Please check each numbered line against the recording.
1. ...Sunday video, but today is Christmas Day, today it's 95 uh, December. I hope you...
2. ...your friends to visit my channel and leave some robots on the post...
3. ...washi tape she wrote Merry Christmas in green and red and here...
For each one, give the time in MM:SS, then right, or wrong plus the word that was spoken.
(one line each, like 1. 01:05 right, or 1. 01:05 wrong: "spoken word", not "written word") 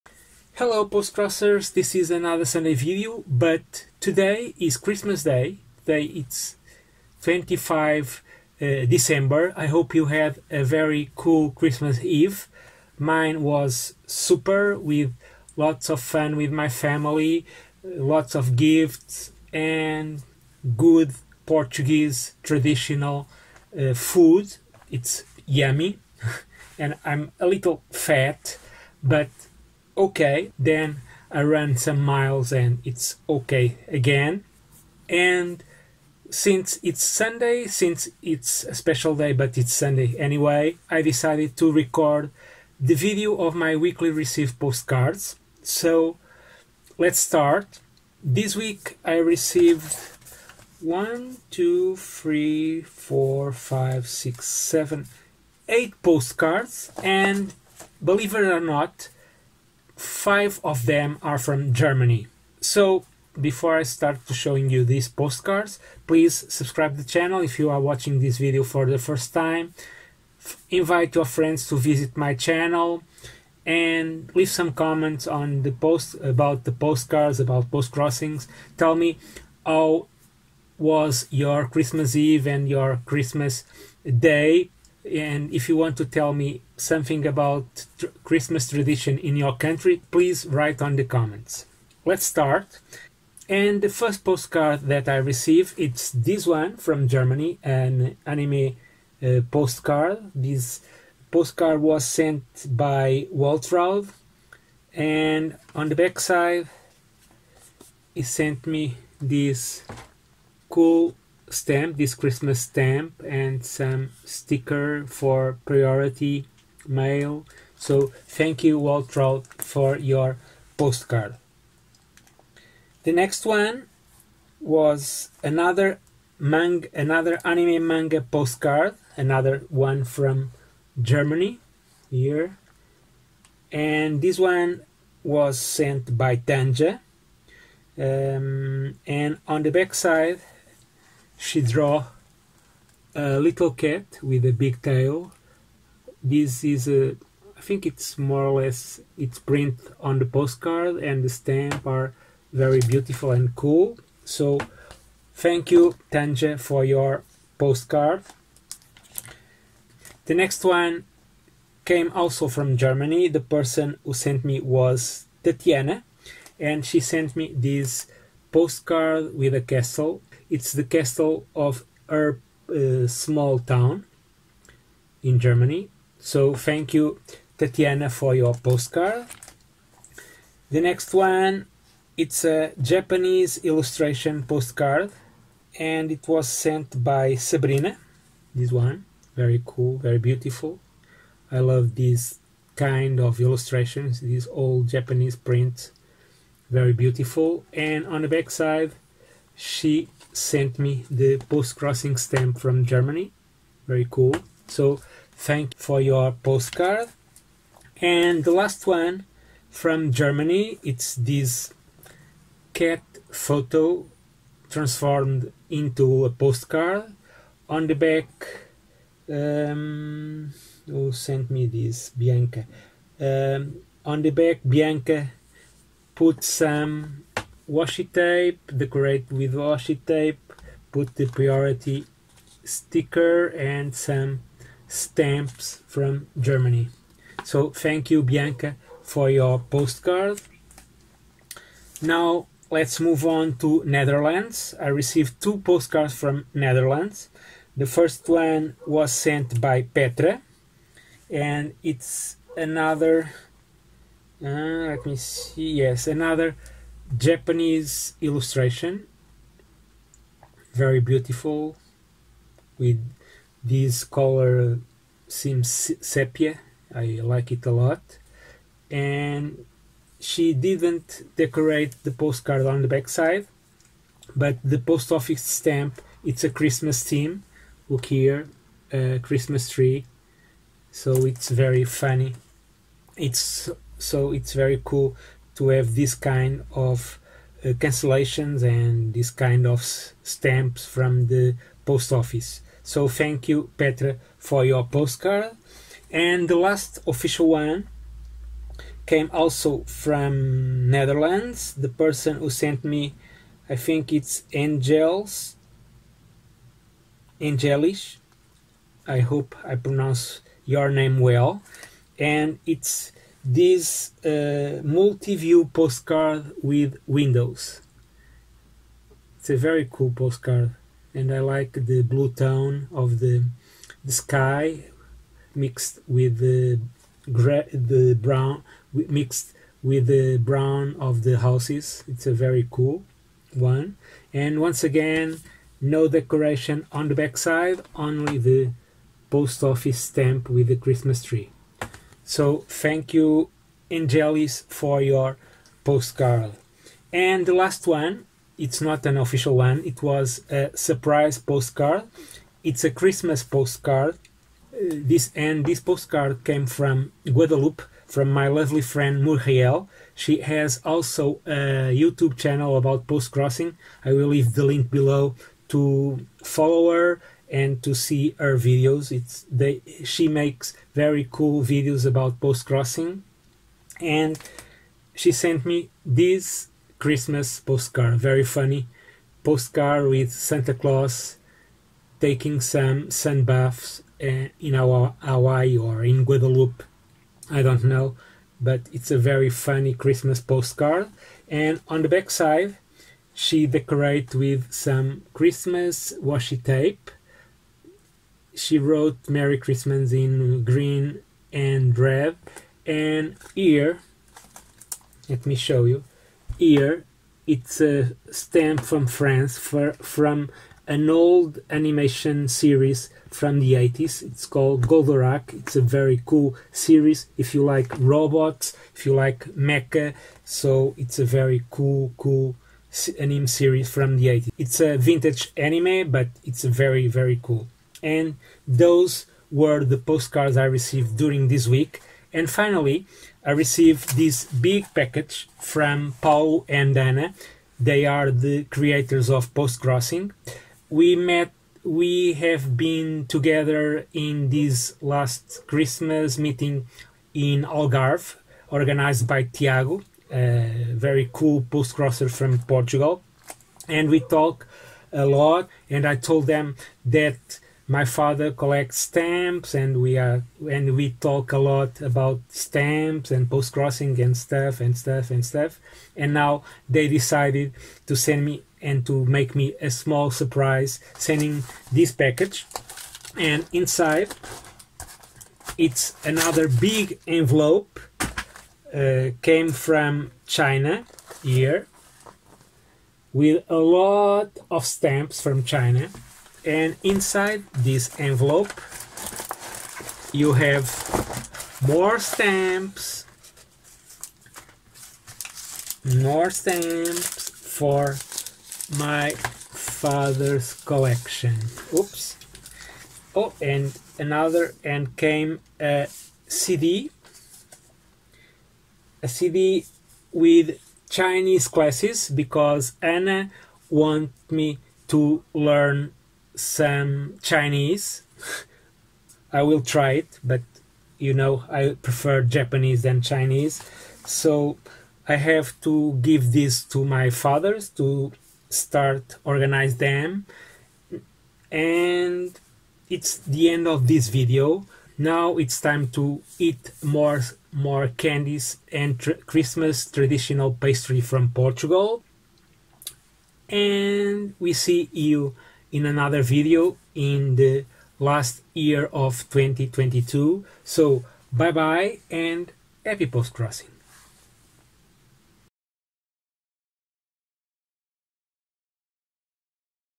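1. 00:02 wrong: "25", not "95"
2. 01:11 wrong: "comments", not "robots"
3. 06:36 right.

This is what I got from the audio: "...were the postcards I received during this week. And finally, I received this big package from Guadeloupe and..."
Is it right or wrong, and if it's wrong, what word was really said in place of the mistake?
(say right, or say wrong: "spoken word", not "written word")
wrong: "Paul", not "Guadeloupe".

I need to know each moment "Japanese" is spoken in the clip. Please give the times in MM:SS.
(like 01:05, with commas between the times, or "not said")
03:02, 03:14, 04:17, 08:42.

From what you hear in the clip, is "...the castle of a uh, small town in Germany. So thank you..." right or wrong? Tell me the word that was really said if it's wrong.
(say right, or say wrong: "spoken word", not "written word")
right.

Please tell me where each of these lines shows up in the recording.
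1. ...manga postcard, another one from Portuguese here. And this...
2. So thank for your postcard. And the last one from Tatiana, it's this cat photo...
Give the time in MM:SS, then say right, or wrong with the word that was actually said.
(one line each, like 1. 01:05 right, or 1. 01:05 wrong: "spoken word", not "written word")
1. 02:07 wrong: "Germany", not "Portuguese"
2. 03:24 wrong: "Germany", not "Tatiana".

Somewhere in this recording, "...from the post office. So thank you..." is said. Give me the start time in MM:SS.
04:50.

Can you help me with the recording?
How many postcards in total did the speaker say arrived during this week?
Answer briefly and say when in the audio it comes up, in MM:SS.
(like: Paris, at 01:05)
8, at 00:55.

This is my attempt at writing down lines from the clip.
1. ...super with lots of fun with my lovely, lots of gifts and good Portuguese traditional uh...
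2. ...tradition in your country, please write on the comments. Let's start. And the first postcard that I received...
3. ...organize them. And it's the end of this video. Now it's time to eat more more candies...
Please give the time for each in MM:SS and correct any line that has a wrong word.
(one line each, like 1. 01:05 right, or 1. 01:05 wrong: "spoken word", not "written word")
1. 00:14 wrong: "family", not "lovely"
2. 01:28 right
3. 08:49 right.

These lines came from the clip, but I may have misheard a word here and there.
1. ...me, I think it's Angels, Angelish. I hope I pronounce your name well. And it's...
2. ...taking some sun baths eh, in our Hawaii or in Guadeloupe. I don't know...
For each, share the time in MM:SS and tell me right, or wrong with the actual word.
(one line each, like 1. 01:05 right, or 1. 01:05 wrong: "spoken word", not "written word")
1. 05:02 right
2. 06:22 right.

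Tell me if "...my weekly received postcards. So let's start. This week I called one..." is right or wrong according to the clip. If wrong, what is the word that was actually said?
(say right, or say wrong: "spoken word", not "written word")
wrong: "received", not "called".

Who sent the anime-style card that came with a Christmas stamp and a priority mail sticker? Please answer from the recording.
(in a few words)
Waltraud.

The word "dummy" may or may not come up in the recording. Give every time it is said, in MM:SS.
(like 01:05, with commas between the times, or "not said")
not said.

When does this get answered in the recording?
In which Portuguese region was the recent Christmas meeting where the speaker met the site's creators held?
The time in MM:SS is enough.
07:27.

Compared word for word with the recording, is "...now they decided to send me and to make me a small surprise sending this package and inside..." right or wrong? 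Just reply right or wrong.
right.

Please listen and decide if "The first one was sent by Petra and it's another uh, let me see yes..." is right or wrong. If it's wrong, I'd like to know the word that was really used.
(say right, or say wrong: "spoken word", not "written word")
right.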